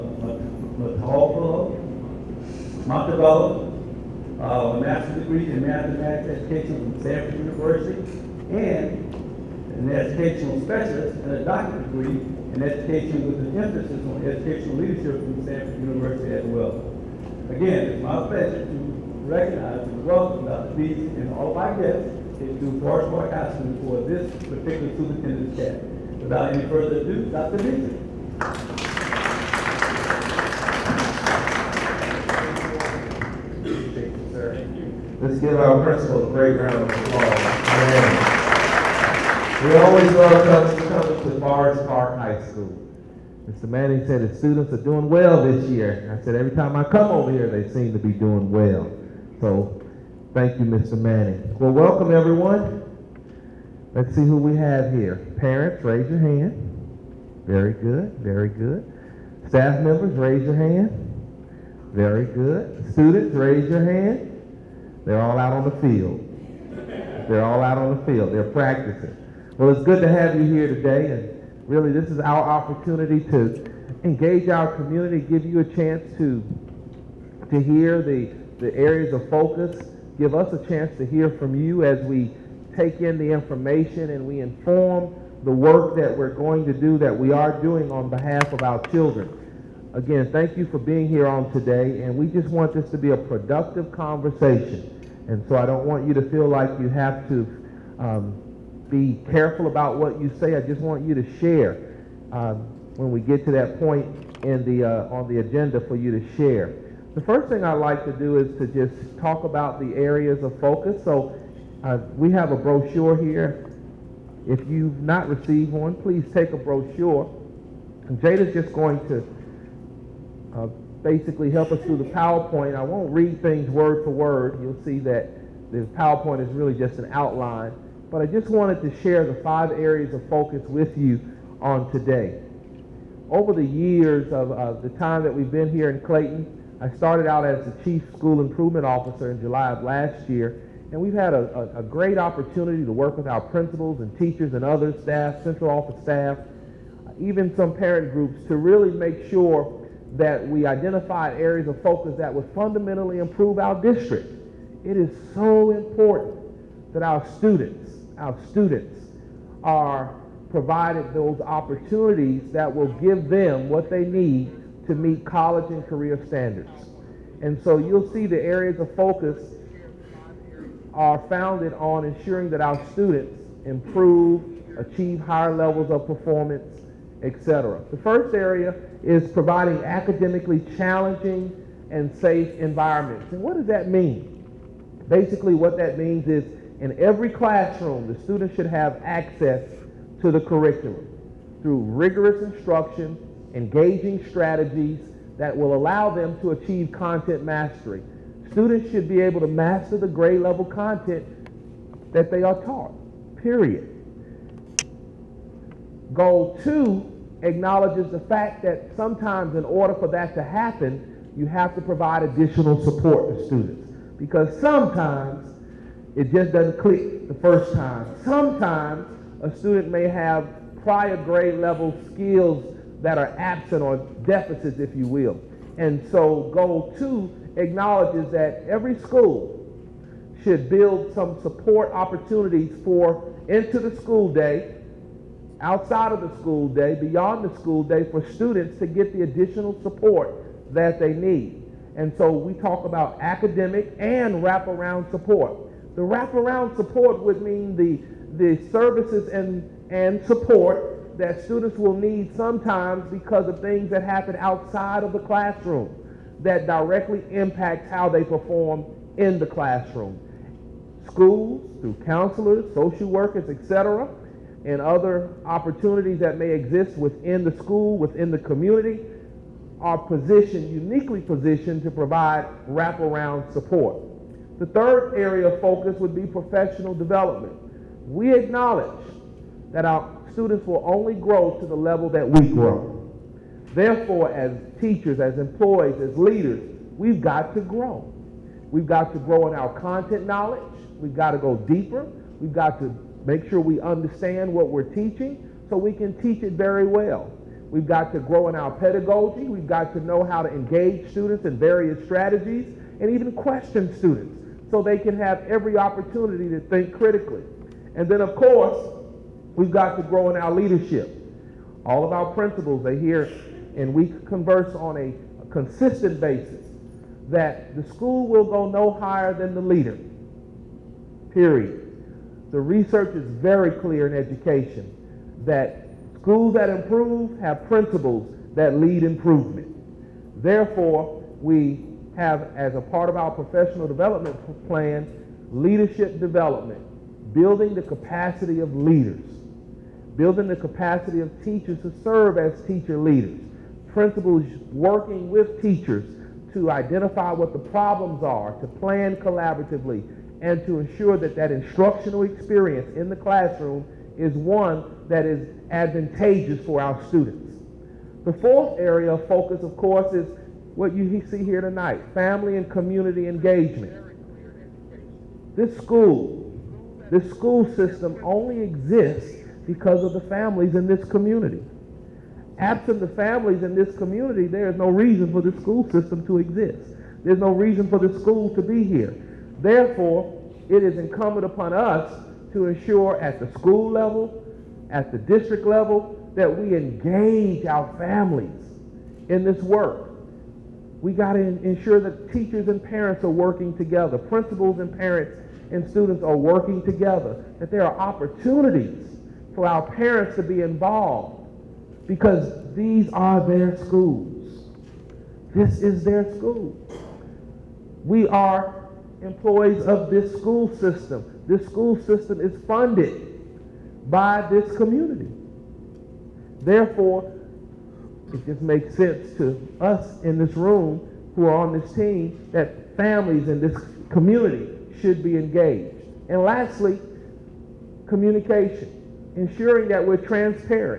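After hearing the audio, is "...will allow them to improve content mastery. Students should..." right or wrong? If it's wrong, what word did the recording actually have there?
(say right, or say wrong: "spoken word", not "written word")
wrong: "achieve", not "improve".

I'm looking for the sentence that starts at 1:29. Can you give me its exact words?
Again, thank you for being here on today, and we just want this to be a productive conversation.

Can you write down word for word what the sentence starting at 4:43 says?
Therefore, as teachers, as employees, as leaders, we've got to grow.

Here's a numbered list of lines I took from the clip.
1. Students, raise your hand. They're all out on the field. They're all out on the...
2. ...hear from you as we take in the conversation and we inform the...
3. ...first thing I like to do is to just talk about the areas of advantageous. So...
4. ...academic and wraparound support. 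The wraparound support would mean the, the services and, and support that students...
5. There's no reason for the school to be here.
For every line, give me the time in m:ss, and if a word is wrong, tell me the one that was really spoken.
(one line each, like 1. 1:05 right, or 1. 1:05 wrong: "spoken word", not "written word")
1. 1:02 right
2. 1:21 wrong: "information", not "conversation"
3. 1:47 wrong: "focus", not "advantageous"
4. 4:03 right
5. 6:17 right.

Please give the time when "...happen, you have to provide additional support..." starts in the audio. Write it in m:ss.
3:30.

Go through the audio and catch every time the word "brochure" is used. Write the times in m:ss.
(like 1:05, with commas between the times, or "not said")
1:52, 1:56.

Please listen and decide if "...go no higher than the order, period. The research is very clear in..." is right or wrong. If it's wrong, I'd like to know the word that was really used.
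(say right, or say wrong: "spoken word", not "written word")
wrong: "leader", not "order".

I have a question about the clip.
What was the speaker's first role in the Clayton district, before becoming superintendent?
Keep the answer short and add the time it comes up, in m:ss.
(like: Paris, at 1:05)
Chief School Improvement Officer, at 2:17.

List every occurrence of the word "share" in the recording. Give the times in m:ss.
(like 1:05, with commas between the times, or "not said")
1:41, 1:46, 2:09.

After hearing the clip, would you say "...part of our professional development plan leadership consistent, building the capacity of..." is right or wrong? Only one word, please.
wrong.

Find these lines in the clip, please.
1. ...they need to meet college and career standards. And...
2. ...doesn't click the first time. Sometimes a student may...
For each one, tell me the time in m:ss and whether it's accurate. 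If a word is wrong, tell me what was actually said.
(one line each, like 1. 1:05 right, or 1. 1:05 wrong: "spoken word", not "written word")
1. 2:43 right
2. 3:36 right.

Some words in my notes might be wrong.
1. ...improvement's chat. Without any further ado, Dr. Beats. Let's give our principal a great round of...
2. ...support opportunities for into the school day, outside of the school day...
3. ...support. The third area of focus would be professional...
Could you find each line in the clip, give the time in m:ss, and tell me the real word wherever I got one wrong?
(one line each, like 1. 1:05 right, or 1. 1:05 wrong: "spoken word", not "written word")
1. 0:24 wrong: "superintendent", not "improvement"
2. 3:51 right
3. 4:33 right.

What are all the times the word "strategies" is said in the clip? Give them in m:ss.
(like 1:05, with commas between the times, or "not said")
3:14, 5:02.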